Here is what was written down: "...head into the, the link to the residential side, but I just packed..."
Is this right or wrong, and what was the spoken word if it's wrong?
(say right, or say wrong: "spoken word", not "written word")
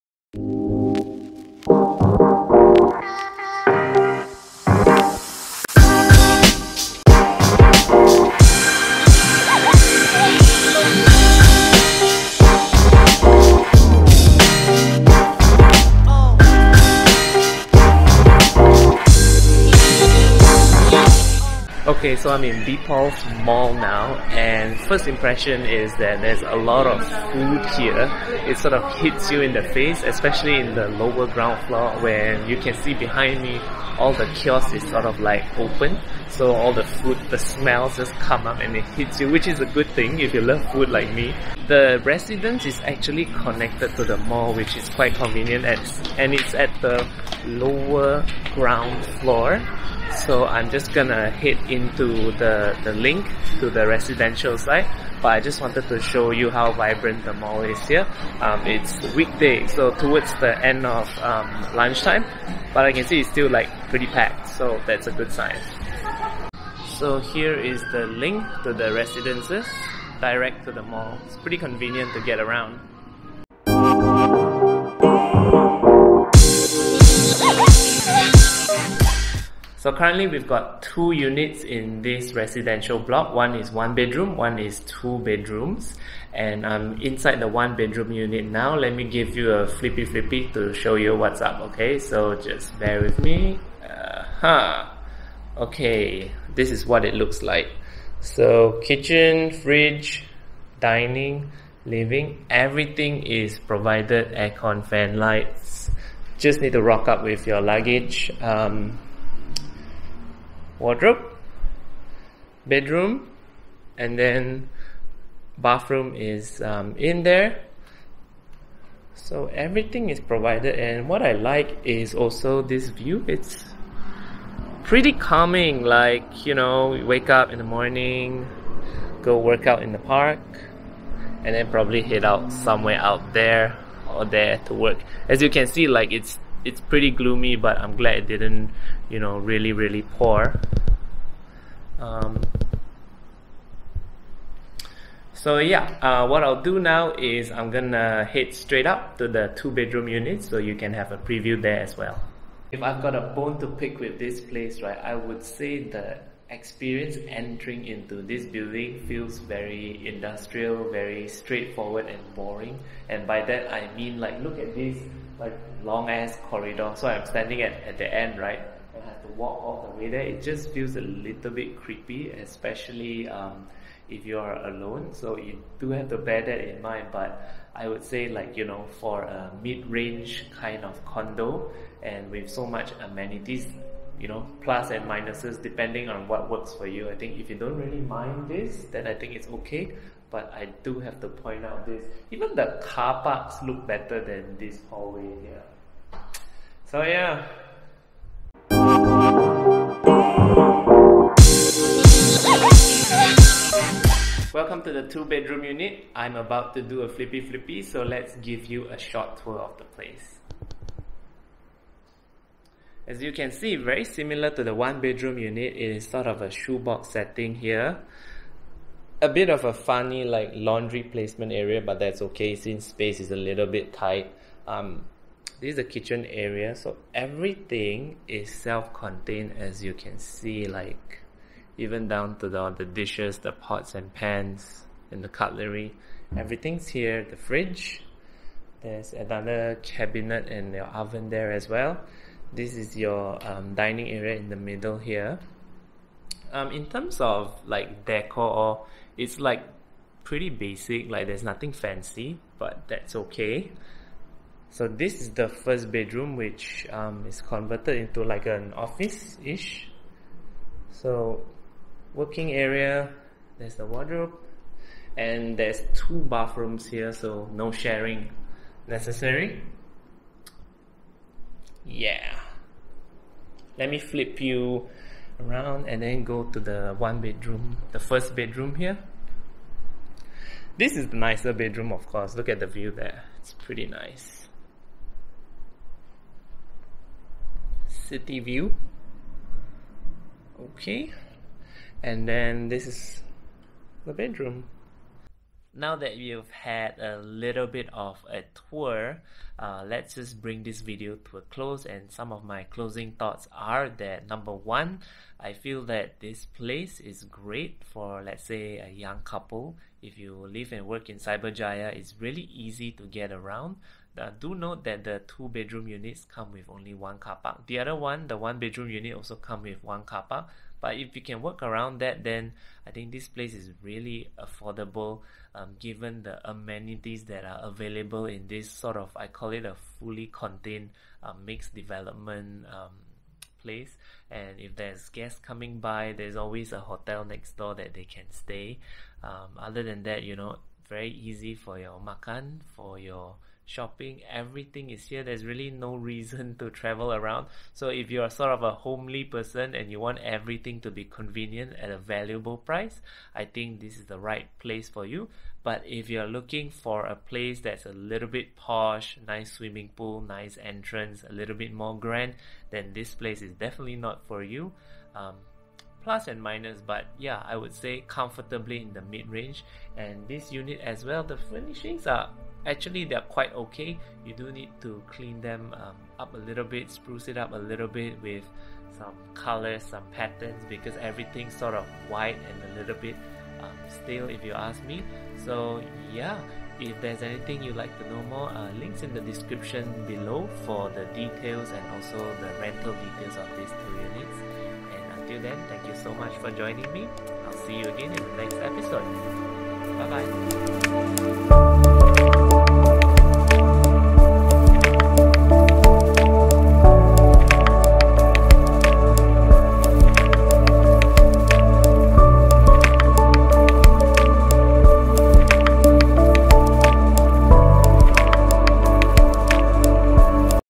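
wrong: "wanted", not "packed".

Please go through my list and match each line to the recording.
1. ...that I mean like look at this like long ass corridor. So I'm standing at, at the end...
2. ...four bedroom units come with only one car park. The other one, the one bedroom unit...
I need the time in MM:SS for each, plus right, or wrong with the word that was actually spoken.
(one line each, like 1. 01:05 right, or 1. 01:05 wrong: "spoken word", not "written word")
1. 02:43 right
2. 05:15 wrong: "two", not "four".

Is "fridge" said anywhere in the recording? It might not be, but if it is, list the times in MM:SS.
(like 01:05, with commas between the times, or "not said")
01:39, 03:57.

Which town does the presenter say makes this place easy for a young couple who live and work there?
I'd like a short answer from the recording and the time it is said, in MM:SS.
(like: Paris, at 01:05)
Cyberjaya, at 05:11.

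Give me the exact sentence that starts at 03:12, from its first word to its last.
Even the car parks look better than this hallway here.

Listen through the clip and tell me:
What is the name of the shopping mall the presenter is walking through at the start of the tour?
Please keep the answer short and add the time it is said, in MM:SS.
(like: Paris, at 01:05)
D'Pulze Mall, at 00:22.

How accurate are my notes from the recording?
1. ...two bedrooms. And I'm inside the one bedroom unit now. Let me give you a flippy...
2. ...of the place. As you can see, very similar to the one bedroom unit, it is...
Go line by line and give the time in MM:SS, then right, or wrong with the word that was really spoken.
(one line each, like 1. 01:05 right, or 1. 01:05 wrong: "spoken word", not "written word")
1. 01:24 right
2. 03:29 right.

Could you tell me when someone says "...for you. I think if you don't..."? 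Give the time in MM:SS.
03:06.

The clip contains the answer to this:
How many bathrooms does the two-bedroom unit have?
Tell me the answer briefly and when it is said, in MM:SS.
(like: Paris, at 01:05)
2, at 04:25.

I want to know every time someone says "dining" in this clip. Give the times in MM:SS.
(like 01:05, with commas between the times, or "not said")
01:40, 04:03.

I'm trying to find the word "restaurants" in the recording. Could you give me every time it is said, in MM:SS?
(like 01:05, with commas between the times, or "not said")
not said.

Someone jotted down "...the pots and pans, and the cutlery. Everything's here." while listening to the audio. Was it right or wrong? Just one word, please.
right.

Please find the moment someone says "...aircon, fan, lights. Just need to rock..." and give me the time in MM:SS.
01:44.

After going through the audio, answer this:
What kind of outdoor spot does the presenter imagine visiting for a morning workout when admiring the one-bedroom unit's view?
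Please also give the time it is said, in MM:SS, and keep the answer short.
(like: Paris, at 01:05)
The park, at 02:09.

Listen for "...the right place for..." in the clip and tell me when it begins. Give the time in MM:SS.
05:54.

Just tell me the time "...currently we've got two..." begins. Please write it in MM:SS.
01:19.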